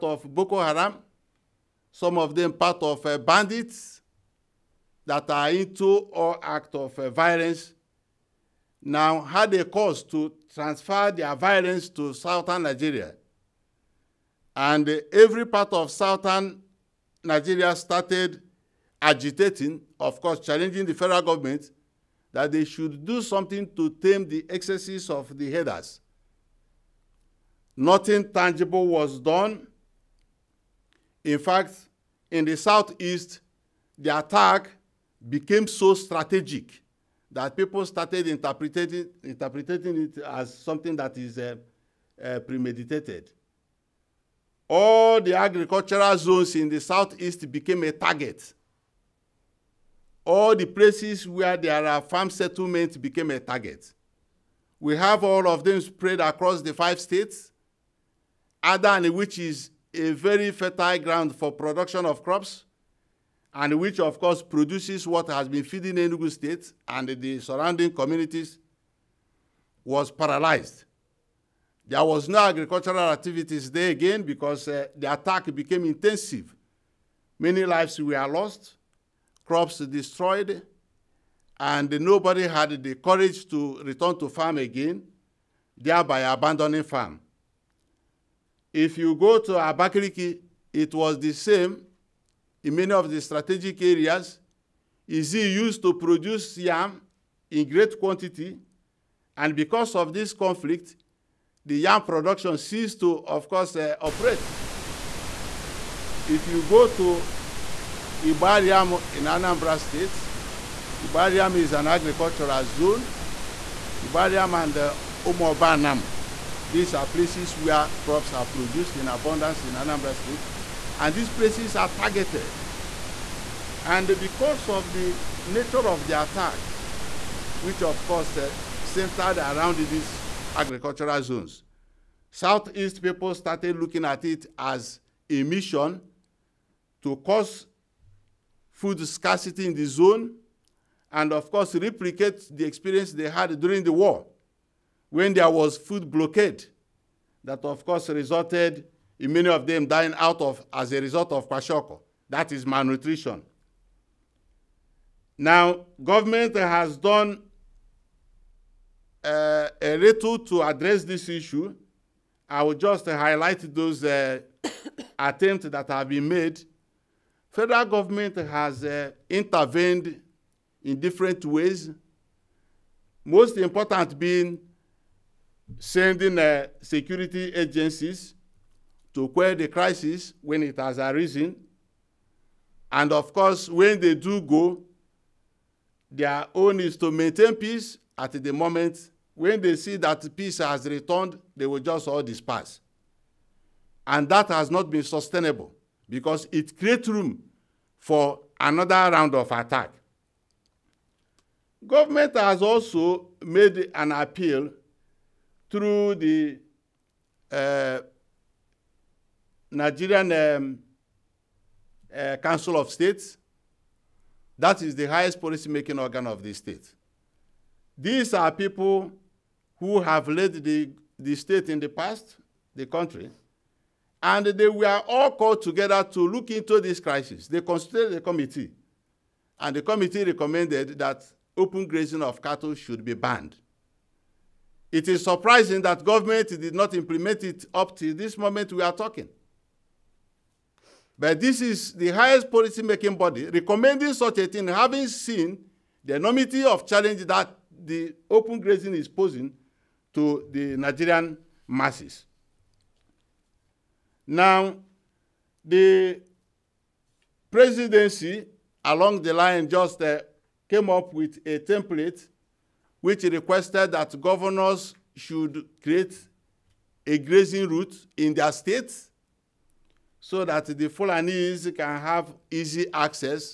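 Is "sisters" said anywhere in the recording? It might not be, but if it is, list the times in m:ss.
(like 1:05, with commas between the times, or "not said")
not said.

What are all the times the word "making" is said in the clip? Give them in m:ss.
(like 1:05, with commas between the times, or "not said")
3:35, 4:02.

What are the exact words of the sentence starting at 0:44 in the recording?
All the agricultural zones in the southeast became a target.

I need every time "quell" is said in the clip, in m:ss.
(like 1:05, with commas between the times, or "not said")
2:59.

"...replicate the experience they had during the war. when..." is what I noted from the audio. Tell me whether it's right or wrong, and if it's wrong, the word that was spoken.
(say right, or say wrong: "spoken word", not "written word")
right.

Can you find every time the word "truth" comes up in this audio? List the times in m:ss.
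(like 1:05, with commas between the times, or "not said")
not said.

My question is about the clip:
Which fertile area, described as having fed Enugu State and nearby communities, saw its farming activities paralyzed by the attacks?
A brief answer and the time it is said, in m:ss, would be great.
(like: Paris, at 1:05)
Adani, at 0:58.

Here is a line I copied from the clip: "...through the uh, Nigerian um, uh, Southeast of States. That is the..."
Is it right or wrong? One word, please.
wrong.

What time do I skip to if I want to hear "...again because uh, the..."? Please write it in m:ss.
1:13.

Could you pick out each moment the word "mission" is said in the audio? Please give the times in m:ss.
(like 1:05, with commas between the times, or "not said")
2:15.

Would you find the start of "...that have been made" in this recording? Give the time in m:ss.
2:45.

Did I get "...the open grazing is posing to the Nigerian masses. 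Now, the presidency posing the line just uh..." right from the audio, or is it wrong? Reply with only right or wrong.
wrong.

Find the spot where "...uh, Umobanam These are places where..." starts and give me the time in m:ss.
1:54.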